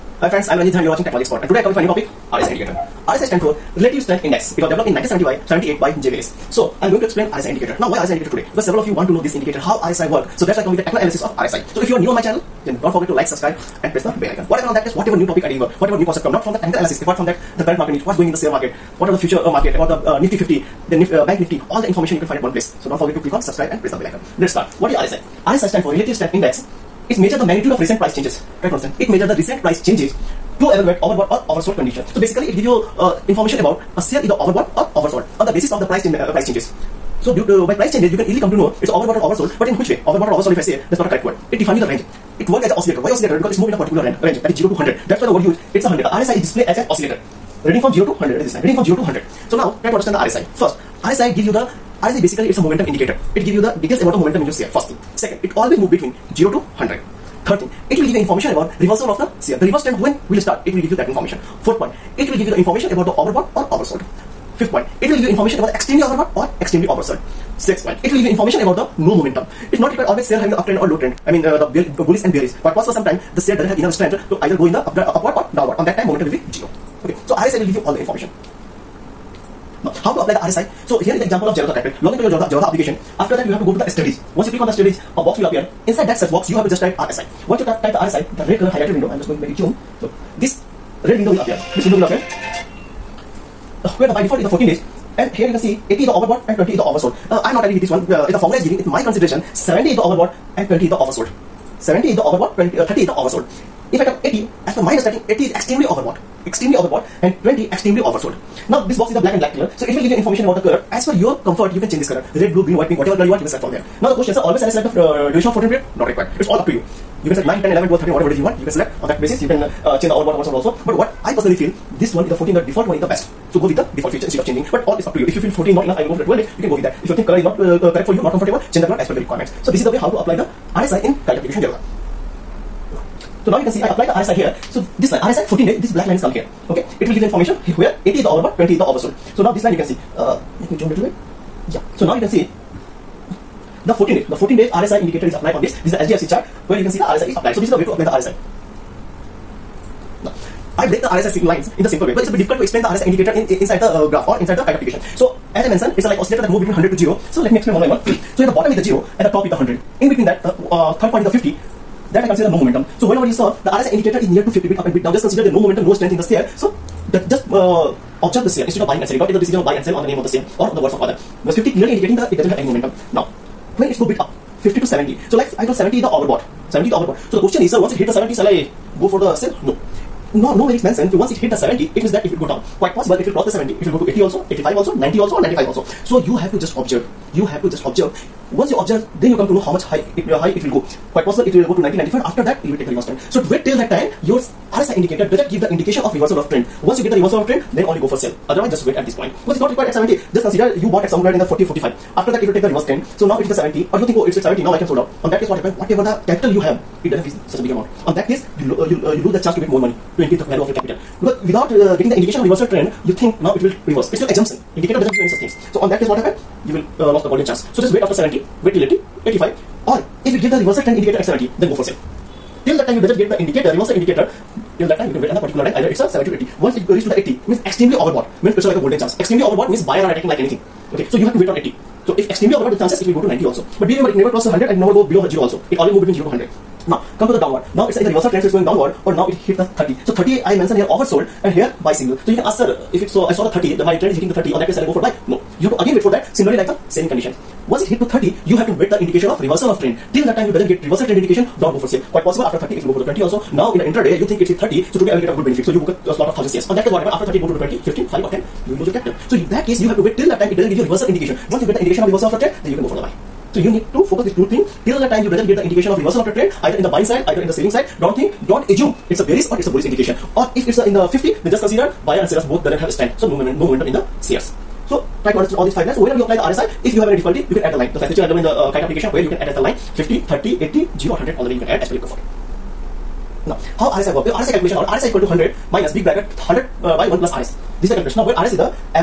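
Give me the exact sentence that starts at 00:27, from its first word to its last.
It measure the magnitude of recent price changes Try to understand.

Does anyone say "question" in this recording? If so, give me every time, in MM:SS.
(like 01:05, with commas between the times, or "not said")
01:54, 02:57.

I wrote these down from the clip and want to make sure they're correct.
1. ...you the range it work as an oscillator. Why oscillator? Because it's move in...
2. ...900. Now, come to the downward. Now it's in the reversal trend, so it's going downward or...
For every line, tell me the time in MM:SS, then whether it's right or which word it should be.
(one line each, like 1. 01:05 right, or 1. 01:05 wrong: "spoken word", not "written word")
1. 00:41 right
2. 03:56 wrong: "100", not "900".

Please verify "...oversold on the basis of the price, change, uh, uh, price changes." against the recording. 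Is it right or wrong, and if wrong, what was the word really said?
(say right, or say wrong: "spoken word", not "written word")
right.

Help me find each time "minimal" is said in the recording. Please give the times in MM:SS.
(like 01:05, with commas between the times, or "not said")
not said.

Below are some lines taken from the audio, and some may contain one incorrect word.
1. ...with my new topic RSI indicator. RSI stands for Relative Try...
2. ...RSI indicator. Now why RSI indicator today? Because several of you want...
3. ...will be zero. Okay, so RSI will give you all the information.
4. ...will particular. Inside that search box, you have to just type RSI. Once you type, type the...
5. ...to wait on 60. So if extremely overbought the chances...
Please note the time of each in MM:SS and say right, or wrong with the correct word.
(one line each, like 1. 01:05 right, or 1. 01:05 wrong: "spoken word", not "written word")
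1. 00:01 wrong: "Strength", not "Try"
2. 00:07 right
3. 01:16 right
4. 01:25 wrong: "appear", not "particular"
5. 03:51 wrong: "80", not "60".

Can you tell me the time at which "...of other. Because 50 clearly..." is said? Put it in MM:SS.
02:50.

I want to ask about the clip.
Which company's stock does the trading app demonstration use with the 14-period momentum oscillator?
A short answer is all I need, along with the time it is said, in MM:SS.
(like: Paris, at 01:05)
HDFC, at 02:26.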